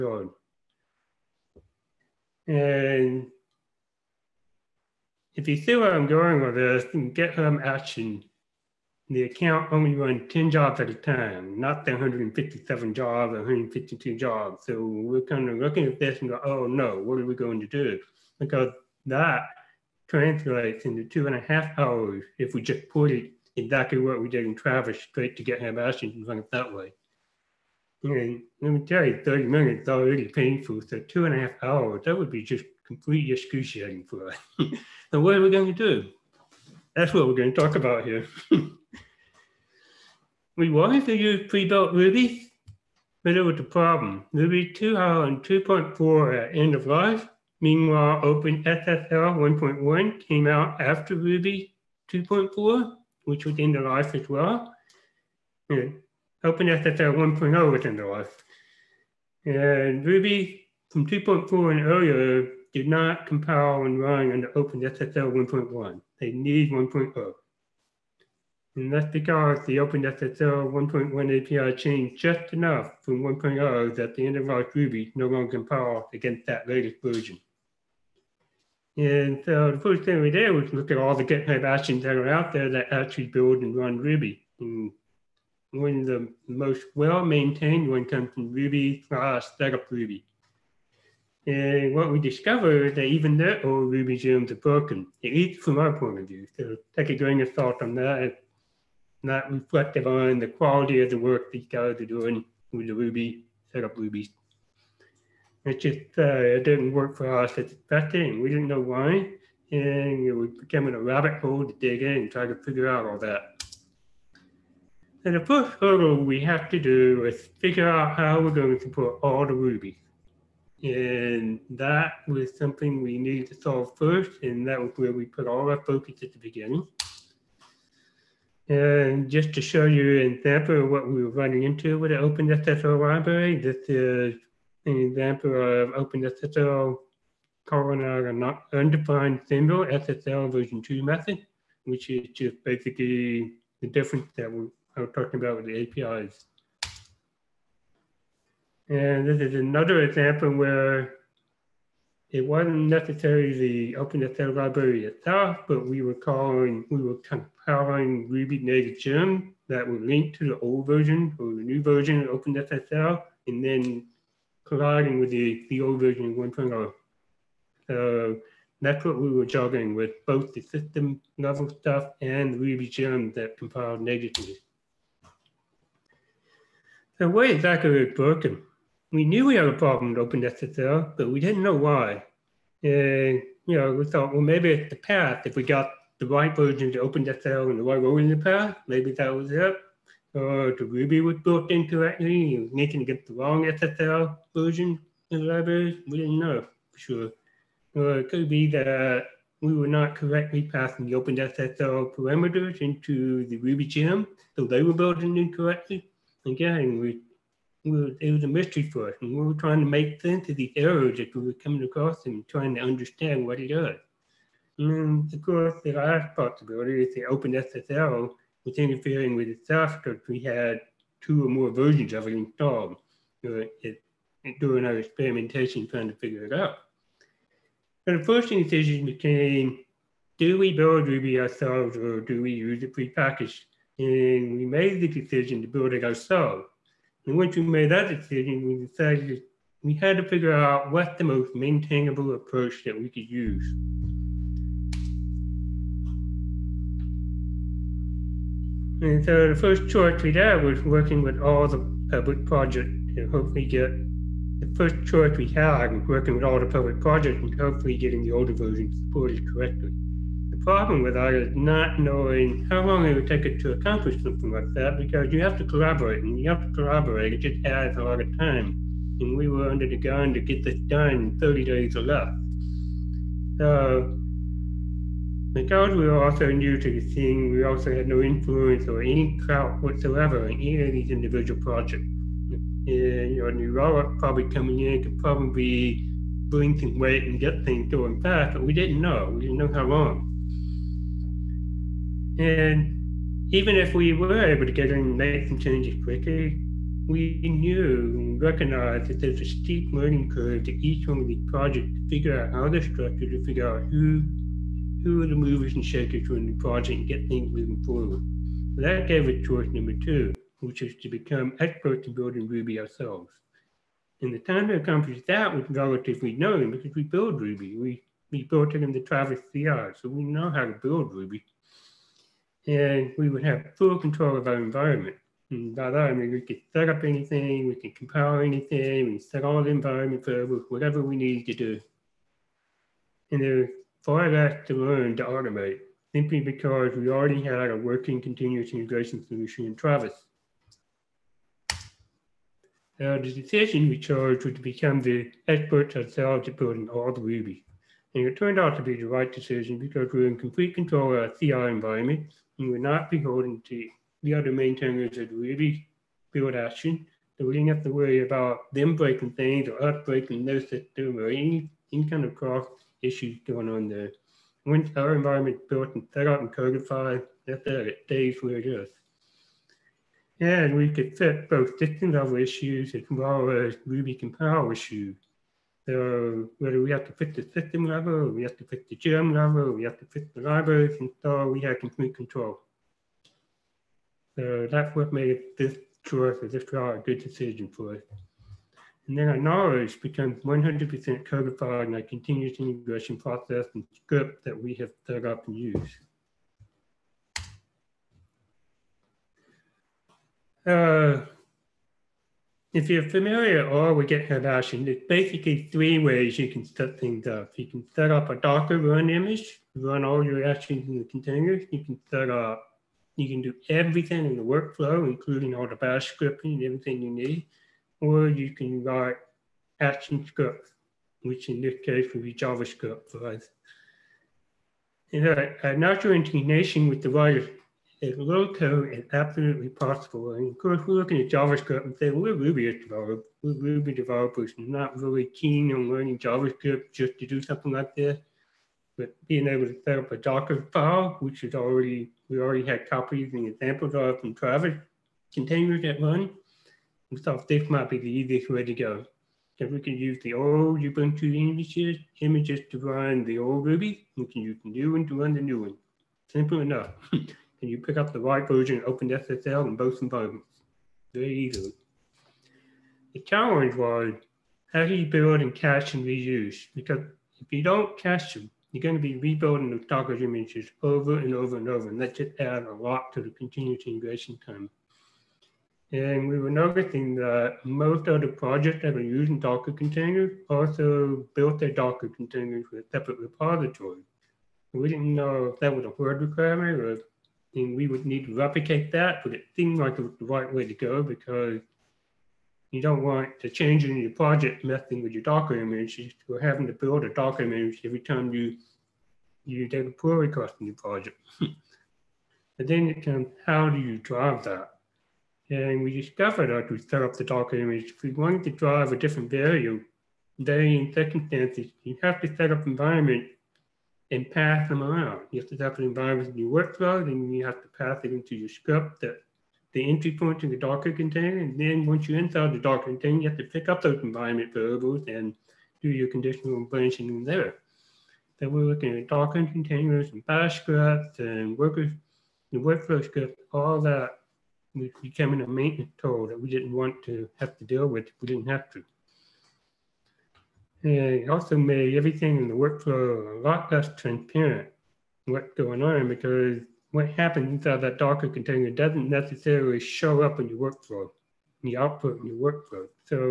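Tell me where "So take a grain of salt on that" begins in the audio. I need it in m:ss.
1:36.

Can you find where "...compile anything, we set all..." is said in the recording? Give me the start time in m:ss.
5:27.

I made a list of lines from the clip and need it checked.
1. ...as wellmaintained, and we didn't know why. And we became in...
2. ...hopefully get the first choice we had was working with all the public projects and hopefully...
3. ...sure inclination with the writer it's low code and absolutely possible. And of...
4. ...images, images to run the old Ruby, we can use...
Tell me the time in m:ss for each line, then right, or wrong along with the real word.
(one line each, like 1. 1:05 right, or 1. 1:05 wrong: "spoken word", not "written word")
1. 1:47 wrong: "expected", not "wellmaintained"
2. 4:13 right
3. 7:05 right
4. 7:31 right.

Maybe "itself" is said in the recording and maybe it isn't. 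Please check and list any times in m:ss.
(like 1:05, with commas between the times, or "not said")
2:35, 3:39.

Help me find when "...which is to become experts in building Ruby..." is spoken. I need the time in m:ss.
5:10.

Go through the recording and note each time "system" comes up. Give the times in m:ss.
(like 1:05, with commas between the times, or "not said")
2:50, 6:00, 6:11, 6:17.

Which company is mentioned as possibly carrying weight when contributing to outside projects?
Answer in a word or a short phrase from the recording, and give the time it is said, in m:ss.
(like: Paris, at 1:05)
New Relic, at 4:43.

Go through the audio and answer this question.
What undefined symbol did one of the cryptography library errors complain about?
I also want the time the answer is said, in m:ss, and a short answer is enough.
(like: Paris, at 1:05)
SSL version 2 method, at 2:19.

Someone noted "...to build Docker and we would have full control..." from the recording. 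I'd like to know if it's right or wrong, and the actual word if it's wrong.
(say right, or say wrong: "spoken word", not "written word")
wrong: "Ruby", not "Docker".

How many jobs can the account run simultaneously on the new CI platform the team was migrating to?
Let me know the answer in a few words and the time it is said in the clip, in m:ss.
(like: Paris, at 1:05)
10, at 0:10.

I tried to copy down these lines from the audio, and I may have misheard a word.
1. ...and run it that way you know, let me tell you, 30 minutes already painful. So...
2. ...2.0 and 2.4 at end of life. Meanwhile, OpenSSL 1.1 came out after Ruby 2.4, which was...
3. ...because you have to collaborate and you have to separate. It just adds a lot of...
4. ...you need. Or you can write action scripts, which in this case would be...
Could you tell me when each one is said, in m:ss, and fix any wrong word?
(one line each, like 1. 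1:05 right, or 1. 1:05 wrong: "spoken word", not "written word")
1. 0:26 right
2. 0:44 right
3. 4:24 wrong: "collaborate", not "separate"
4. 6:57 right.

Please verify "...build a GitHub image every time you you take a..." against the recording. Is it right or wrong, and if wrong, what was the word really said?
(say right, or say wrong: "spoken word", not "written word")
wrong: "Docker", not "GitHub".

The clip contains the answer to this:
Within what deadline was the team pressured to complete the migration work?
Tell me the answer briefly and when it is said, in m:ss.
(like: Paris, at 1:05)
30 days, at 4:31.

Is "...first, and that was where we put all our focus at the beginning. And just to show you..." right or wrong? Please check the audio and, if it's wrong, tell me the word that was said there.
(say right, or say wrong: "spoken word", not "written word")
right.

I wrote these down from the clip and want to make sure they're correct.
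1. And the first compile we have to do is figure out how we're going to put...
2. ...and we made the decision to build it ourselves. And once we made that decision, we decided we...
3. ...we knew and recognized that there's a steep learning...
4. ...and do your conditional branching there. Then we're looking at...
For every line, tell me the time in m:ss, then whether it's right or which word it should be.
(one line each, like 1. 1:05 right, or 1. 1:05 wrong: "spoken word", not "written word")
1. 1:55 wrong: "hurdle", not "compile"
2. 3:53 right
3. 4:57 right
4. 8:45 right.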